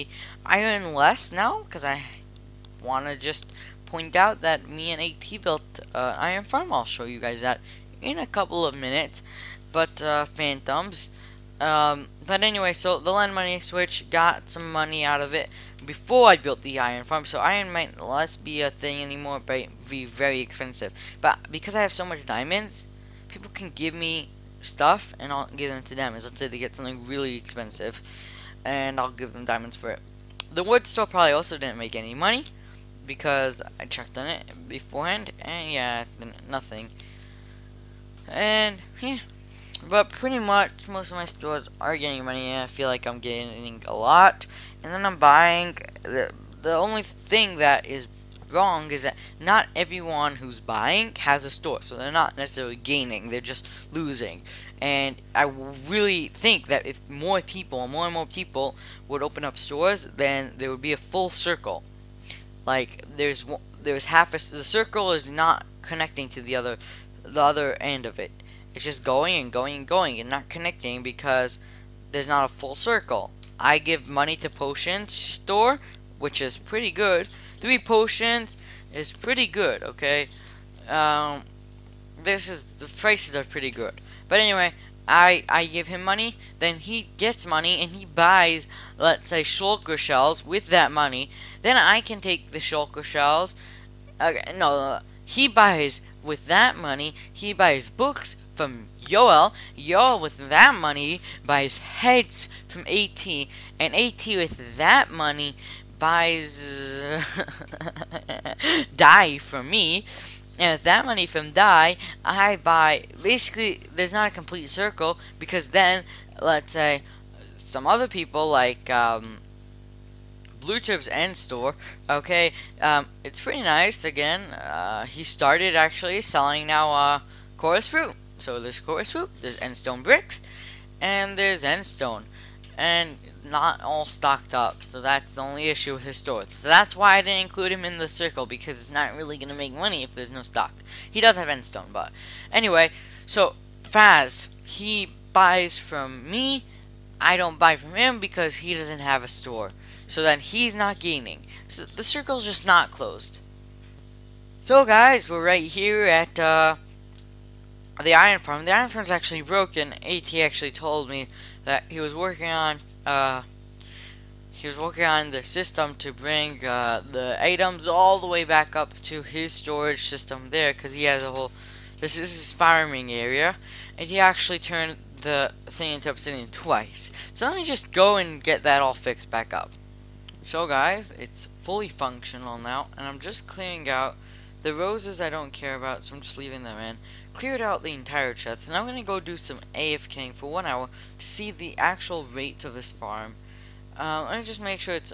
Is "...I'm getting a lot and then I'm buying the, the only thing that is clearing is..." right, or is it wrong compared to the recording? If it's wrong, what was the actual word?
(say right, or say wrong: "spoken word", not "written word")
wrong: "wrong", not "clearing".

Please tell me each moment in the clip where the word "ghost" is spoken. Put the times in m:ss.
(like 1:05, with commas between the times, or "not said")
not said.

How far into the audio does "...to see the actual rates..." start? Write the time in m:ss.
3:11.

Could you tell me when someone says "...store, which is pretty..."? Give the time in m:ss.
1:15.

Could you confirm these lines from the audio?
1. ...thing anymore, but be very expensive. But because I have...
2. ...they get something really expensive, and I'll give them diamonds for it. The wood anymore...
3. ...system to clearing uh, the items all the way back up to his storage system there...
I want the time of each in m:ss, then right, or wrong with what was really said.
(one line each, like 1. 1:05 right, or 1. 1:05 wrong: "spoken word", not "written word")
1. 0:18 right
2. 0:26 wrong: "store", not "anymore"
3. 2:45 wrong: "bring", not "clearing".